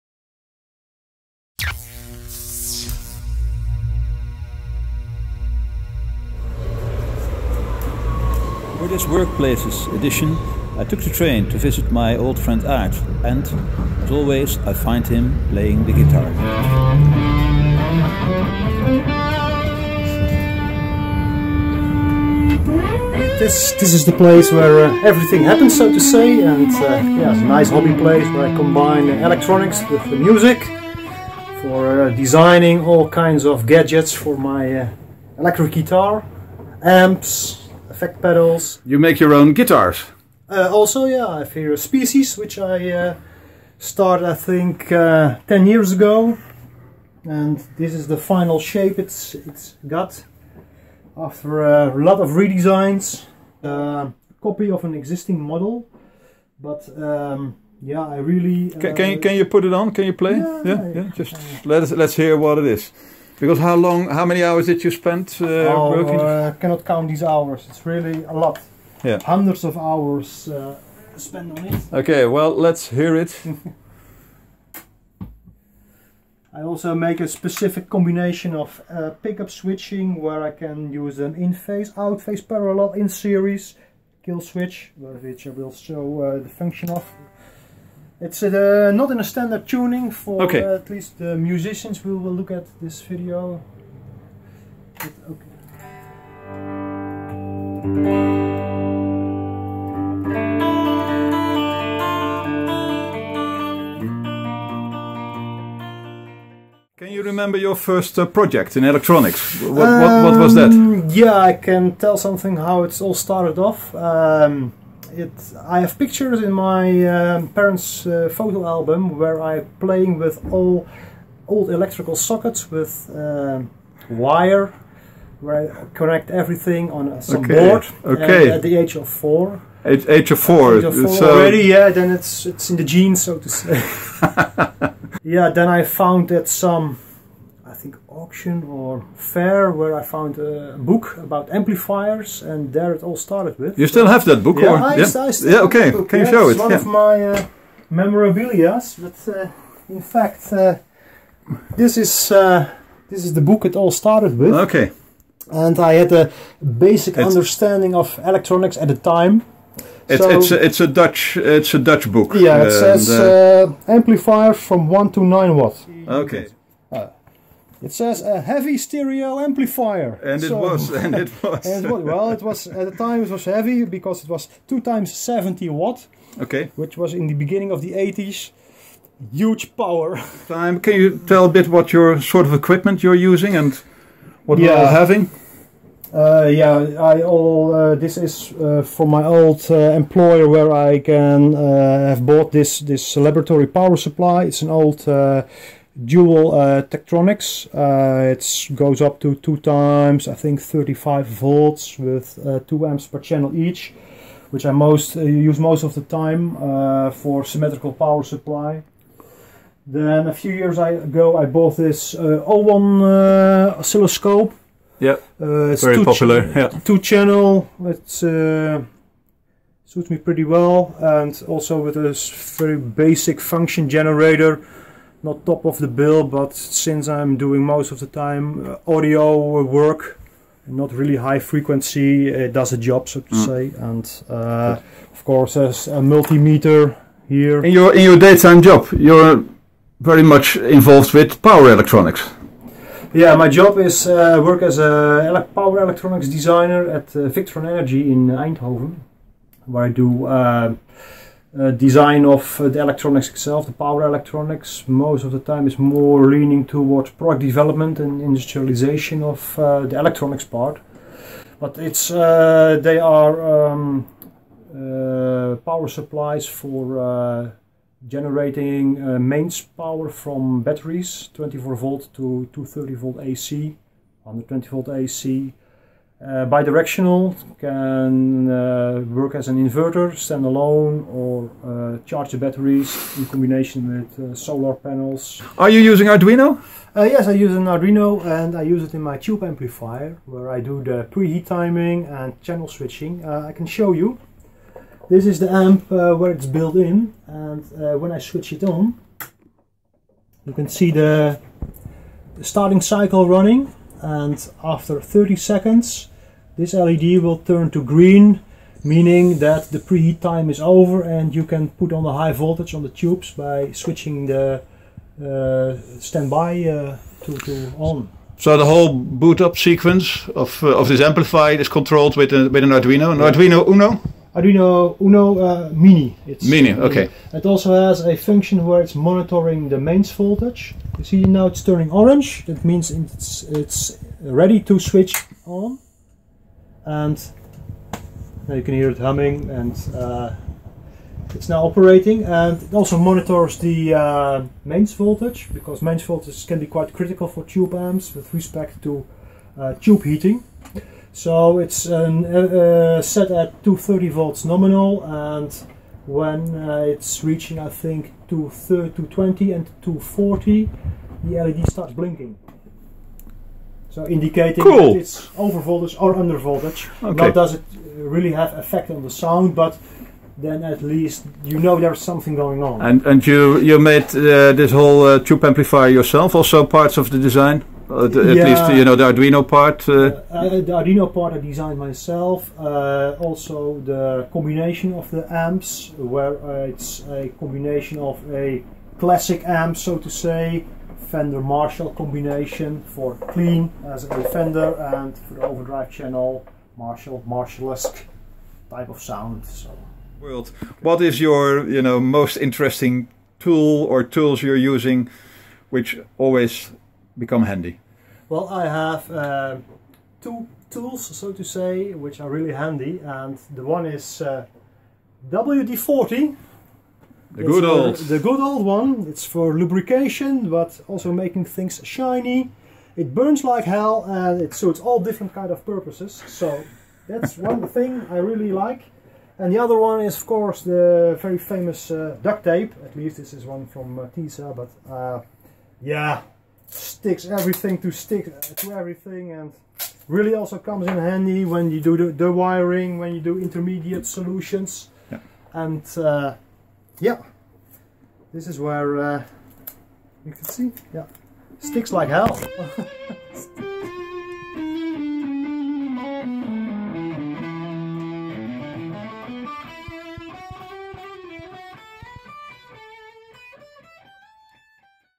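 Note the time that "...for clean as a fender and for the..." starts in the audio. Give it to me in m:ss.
6:32.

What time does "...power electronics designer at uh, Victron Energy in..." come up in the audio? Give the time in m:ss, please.
4:05.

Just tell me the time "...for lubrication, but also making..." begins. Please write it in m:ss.
6:59.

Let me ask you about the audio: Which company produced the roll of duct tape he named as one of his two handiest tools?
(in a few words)
tesa.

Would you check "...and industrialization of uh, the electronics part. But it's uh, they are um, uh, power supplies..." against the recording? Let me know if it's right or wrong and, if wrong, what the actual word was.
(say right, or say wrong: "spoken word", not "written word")
right.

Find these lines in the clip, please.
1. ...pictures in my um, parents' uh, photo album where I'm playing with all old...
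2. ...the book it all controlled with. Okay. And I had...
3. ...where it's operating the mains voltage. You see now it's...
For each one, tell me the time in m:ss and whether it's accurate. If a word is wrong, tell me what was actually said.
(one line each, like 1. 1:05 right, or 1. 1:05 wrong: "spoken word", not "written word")
1. 1:55 right
2. 2:33 wrong: "started", not "controlled"
3. 5:28 wrong: "monitoring", not "operating".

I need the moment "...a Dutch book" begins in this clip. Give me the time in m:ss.
2:41.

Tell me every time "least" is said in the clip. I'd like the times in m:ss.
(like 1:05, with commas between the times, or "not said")
1:30, 6:10, 6:18, 7:12.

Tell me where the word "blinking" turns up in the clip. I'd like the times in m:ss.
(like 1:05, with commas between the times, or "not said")
6:01.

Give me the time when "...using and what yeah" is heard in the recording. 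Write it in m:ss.
3:03.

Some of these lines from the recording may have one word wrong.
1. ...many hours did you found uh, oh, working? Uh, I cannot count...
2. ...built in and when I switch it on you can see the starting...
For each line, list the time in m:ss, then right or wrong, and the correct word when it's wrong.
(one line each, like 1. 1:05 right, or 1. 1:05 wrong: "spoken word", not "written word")
1. 1:04 wrong: "spend", not "found"
2. 4:56 right.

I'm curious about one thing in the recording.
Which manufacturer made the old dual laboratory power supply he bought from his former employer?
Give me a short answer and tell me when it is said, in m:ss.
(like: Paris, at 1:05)
Tektronix, at 3:16.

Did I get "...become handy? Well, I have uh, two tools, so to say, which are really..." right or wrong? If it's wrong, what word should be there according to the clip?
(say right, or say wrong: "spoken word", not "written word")
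right.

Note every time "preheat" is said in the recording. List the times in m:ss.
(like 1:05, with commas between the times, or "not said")
4:51, 5:09.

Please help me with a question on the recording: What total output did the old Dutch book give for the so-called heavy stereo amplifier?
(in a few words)
2 x 70 watt.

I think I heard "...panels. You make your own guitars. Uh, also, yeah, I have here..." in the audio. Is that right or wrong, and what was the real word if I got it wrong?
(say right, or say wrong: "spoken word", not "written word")
wrong: "pedals", not "panels".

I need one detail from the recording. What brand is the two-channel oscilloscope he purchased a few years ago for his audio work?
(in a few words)
Owon.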